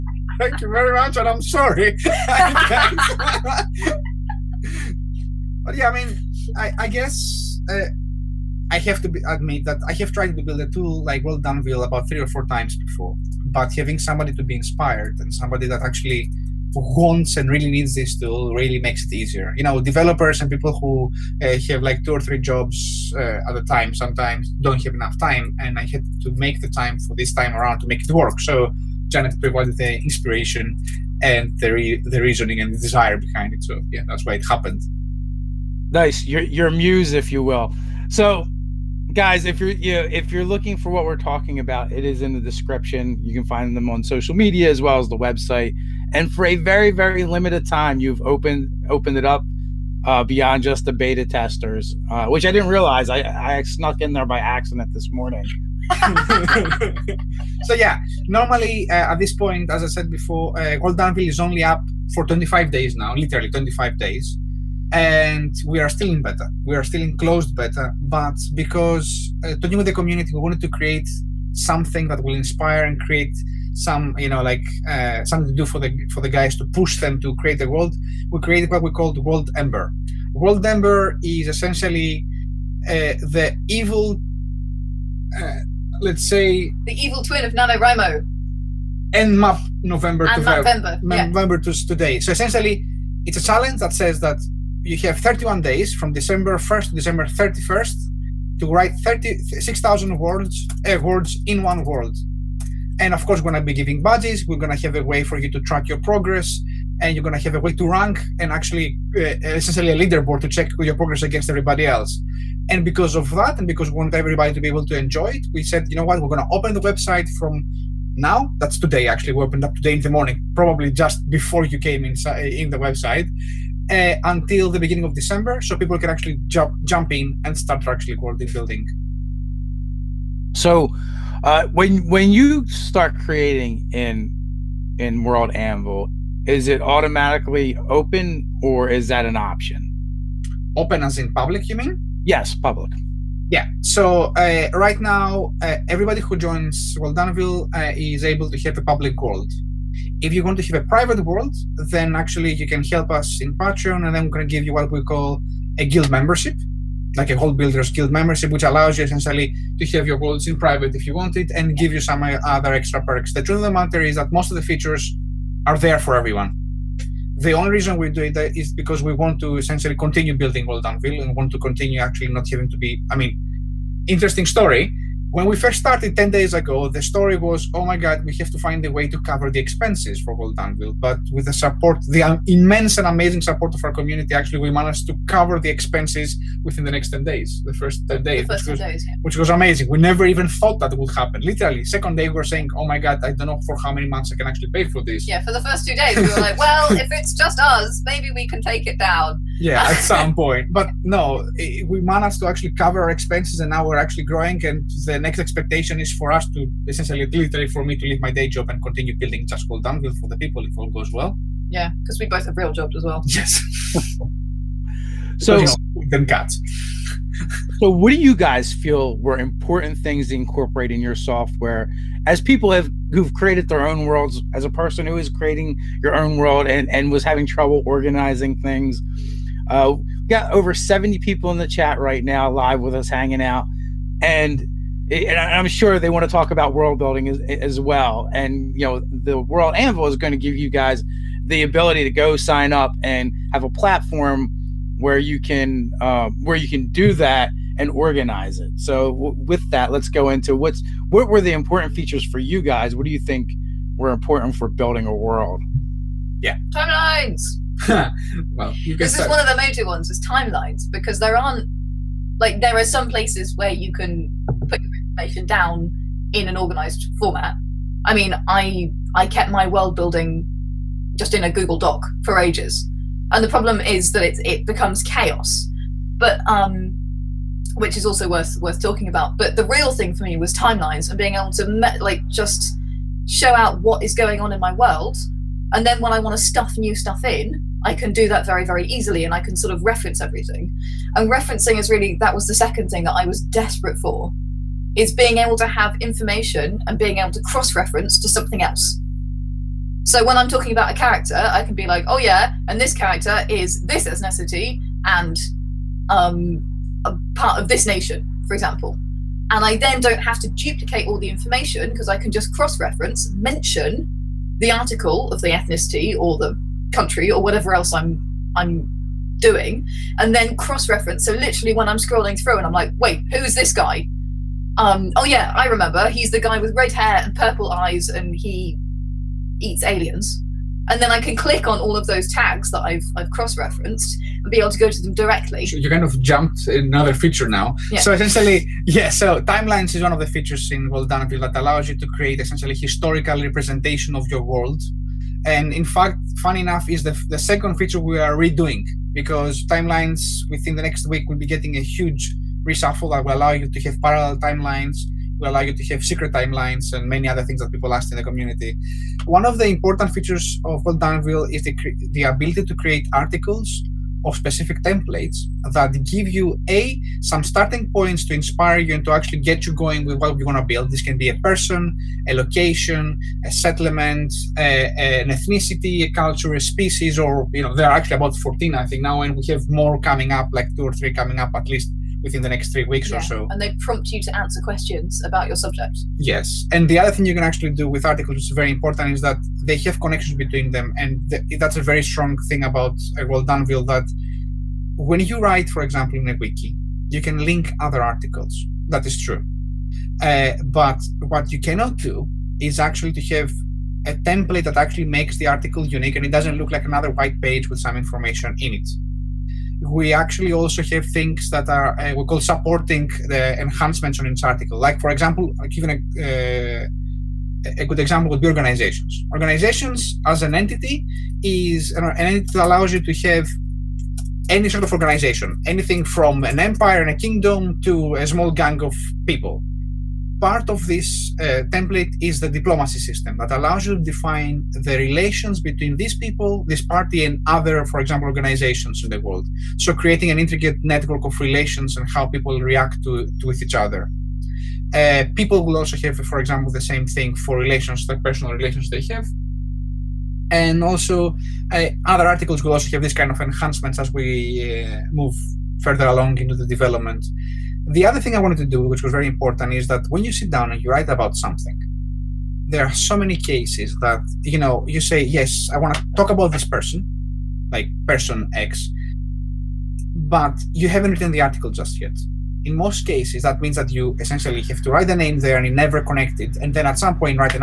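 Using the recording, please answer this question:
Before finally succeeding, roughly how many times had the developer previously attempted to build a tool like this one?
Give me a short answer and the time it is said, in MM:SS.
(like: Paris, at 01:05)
3 or 4 times, at 00:12.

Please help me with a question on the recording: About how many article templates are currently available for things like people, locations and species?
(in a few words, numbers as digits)
14.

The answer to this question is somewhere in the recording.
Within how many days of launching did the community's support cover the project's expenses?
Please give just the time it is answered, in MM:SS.
03:07.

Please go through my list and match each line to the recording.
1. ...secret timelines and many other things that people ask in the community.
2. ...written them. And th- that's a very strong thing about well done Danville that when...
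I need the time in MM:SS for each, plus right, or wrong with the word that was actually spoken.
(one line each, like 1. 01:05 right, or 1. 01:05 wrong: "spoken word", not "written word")
1. 05:56 right
2. 06:30 wrong: "between", not "written".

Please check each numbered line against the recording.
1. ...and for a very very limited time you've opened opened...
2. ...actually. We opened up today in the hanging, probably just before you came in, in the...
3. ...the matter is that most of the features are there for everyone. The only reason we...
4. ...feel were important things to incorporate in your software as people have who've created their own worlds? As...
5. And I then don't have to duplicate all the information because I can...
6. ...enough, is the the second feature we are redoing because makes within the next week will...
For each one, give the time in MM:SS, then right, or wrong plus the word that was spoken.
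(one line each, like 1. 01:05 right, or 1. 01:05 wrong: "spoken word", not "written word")
1. 00:46 right
2. 01:59 wrong: "morning", not "hanging"
3. 02:43 right
4. 03:38 right
5. 05:09 right
6. 05:46 wrong: "timelines", not "makes".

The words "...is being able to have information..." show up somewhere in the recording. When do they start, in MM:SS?
04:55.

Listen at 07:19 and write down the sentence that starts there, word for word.
So creating an intricate network of relations and how people react to, to with each other.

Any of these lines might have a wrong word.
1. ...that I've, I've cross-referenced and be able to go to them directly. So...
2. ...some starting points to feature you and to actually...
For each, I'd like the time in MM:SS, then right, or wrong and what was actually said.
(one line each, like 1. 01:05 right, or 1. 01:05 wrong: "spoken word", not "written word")
1. 05:32 right
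2. 06:07 wrong: "inspire", not "feature".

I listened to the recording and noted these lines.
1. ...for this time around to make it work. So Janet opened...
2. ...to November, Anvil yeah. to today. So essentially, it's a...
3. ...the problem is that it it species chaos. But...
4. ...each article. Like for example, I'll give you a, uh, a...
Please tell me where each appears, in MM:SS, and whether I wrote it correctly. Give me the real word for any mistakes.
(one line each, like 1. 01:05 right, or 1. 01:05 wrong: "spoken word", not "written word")
1. 00:26 wrong: "provided", not "opened"
2. 01:30 wrong: "November", not "Anvil"
3. 04:33 wrong: "becomes", not "species"
4. 06:54 right.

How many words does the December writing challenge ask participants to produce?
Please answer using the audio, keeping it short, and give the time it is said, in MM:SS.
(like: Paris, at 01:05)
36,000, at 01:39.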